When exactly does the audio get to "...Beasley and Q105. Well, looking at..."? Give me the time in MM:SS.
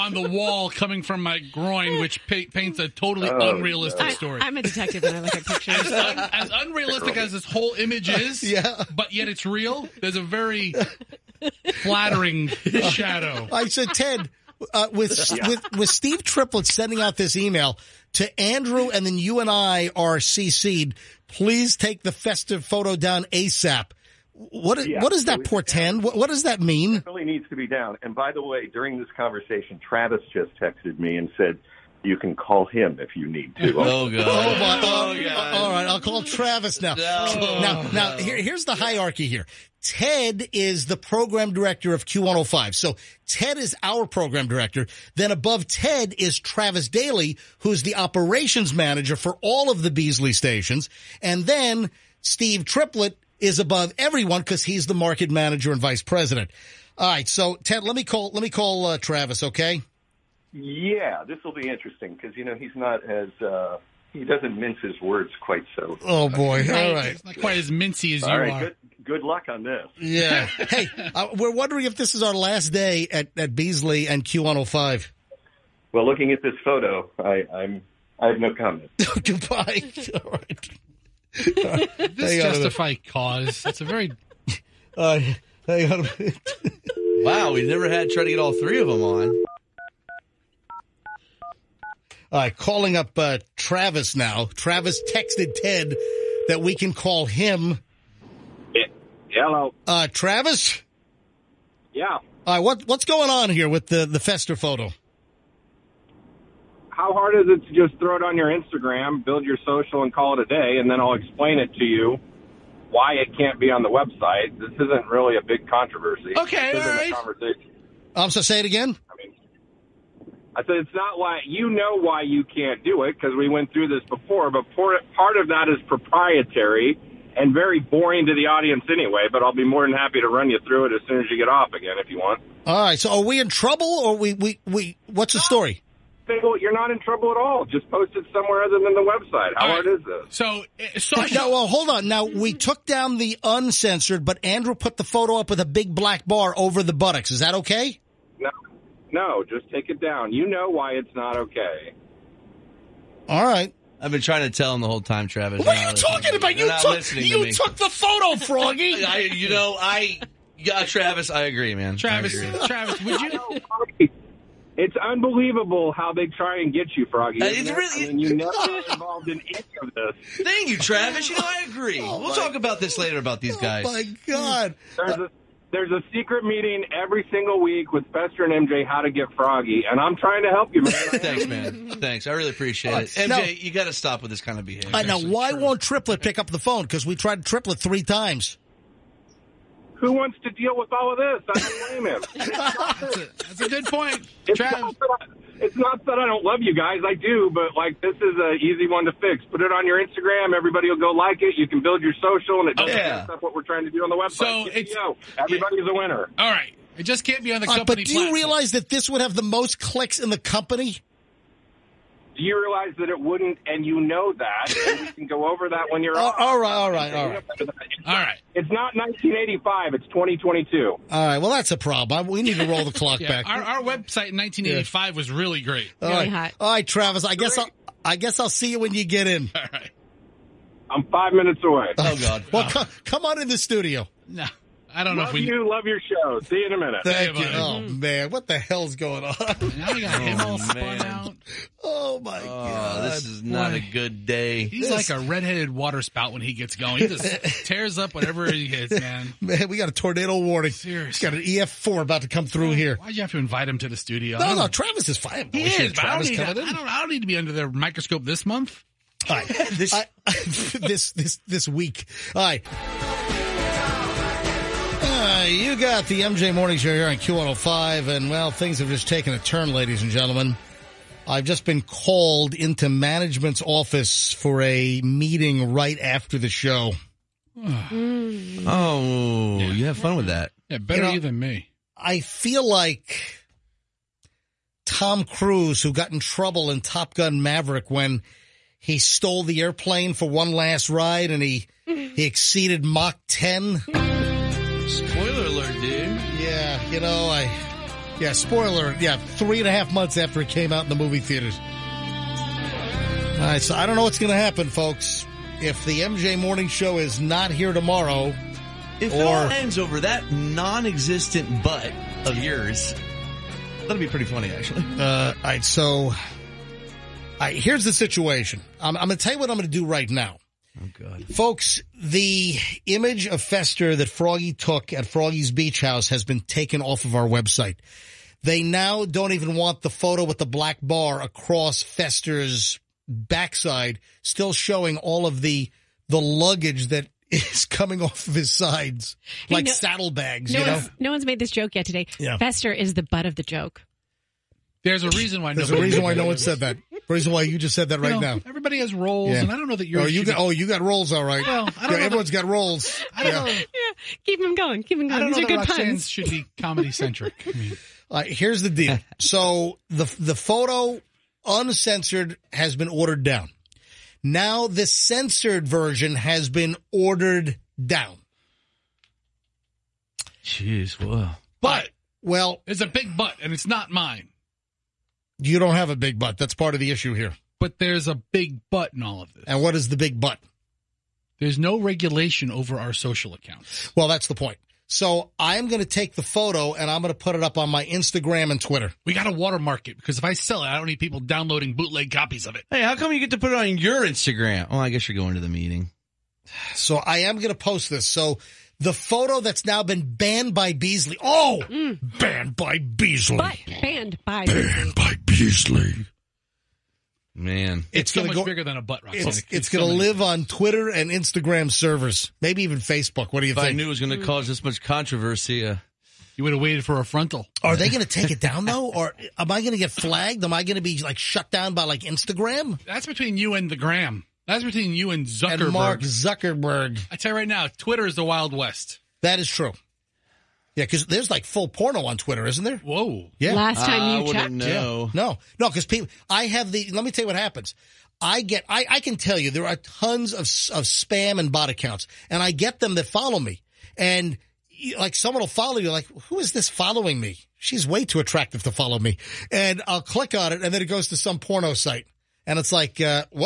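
01:13.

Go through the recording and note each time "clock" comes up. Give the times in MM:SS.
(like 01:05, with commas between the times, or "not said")
03:42.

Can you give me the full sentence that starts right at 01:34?
Travis texted Ted that we can call him.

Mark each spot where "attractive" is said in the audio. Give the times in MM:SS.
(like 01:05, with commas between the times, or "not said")
07:28.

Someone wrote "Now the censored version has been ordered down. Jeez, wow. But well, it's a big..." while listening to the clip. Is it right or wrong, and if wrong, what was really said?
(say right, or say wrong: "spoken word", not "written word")
right.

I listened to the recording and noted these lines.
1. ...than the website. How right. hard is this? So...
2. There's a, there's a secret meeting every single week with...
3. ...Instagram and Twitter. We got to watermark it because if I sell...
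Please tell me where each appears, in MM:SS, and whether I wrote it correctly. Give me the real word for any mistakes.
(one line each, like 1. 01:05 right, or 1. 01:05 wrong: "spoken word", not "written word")
1. 02:18 right
2. 02:54 right
3. 06:27 right.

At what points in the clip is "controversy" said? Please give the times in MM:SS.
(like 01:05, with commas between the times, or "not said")
01:55, 06:54.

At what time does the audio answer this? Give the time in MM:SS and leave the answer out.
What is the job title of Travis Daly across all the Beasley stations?
00:47.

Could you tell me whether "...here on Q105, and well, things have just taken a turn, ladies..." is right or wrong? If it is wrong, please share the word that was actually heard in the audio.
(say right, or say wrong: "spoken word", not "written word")
right.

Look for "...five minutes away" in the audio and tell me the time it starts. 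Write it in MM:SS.
03:51.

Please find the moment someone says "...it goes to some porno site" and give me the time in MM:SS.
07:30.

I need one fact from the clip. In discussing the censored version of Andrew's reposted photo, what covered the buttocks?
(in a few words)
a big black bar.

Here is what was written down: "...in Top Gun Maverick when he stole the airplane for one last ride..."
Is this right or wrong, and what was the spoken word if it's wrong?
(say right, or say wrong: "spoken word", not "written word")
right.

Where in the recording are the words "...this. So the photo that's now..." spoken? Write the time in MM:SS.
06:37.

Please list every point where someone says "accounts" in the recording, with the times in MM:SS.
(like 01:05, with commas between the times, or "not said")
06:23, 07:21.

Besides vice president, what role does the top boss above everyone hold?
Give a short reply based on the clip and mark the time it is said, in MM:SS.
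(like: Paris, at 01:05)
market manager, at 00:54.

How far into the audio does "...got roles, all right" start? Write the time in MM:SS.
05:50.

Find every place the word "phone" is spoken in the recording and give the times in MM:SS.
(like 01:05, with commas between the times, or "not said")
03:06.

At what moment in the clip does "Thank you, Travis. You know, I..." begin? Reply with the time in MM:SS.
02:50.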